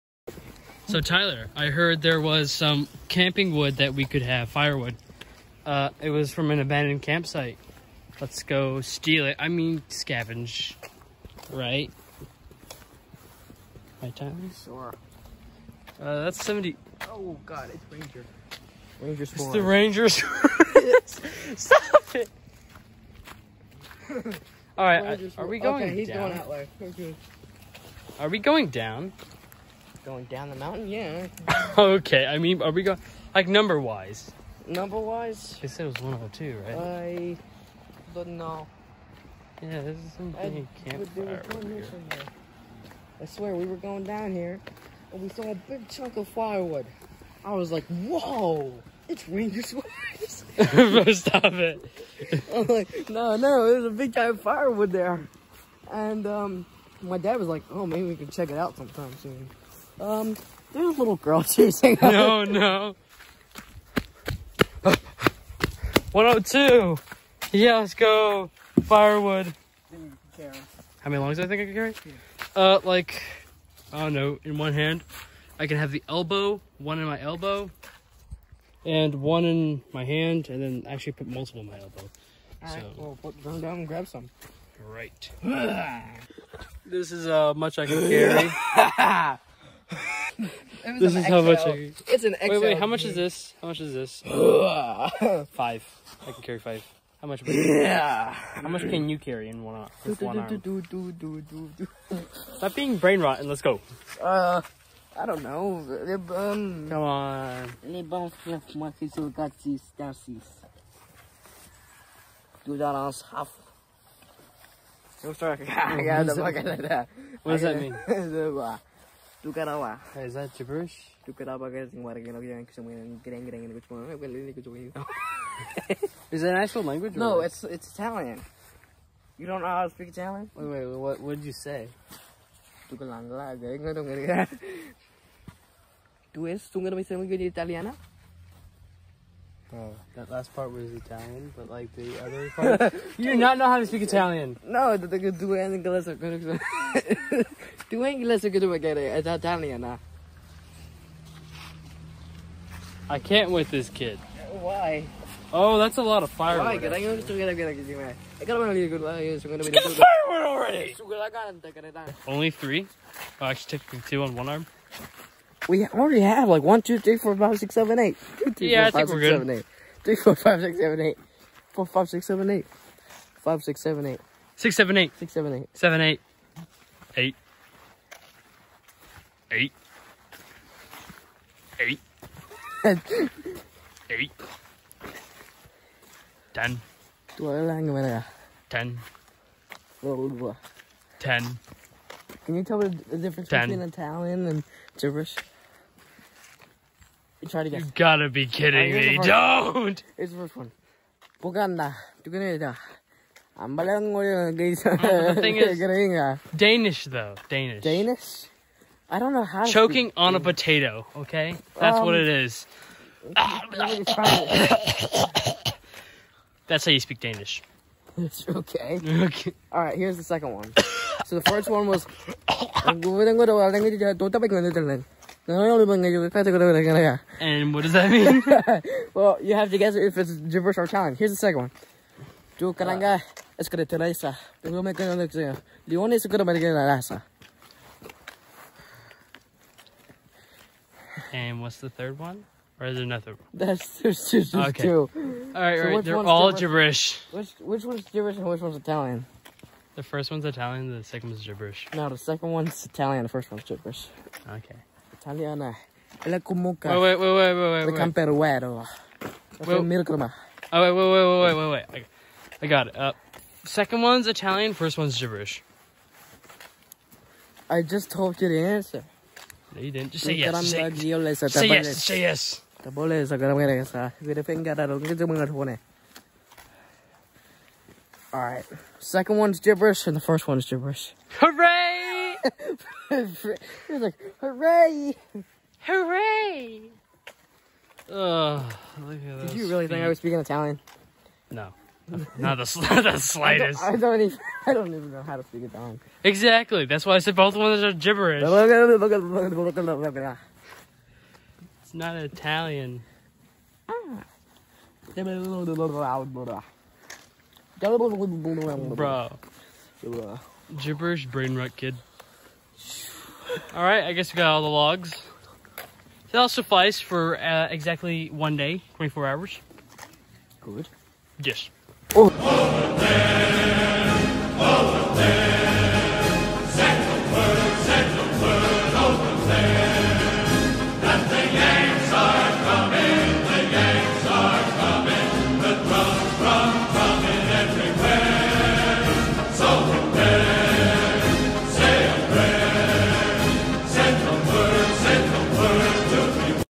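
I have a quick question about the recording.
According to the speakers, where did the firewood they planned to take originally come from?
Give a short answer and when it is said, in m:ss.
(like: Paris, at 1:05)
an abandoned campsite, at 0:06.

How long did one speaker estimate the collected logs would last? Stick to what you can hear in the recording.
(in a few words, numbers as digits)
24 hours.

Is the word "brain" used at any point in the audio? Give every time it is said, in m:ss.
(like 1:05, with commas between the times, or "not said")
1:42, 5:11.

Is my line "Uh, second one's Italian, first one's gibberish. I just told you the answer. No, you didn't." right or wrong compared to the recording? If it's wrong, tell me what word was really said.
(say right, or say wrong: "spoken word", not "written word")
right.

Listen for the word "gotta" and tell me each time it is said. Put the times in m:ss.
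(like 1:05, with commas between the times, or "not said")
3:17.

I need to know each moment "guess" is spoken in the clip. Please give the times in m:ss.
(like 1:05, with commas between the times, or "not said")
3:17, 3:49, 5:14.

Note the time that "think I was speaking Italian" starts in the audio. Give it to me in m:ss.
4:49.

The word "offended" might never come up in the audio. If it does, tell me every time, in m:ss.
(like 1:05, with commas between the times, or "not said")
not said.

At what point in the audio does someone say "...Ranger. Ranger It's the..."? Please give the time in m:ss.
0:17.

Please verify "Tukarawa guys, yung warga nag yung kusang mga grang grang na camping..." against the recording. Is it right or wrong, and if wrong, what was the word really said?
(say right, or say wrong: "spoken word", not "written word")
wrong: "kusang", not "camping".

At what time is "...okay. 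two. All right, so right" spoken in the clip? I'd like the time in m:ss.
4:04.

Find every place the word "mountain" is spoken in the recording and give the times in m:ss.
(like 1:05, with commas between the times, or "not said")
0:30.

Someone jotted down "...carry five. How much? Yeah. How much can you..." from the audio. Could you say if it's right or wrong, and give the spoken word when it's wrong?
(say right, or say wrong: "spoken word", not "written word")
right.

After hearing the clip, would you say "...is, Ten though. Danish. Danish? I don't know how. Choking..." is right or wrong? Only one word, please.
wrong.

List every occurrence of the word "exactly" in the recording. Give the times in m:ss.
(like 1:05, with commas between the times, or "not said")
4:56, 5:17.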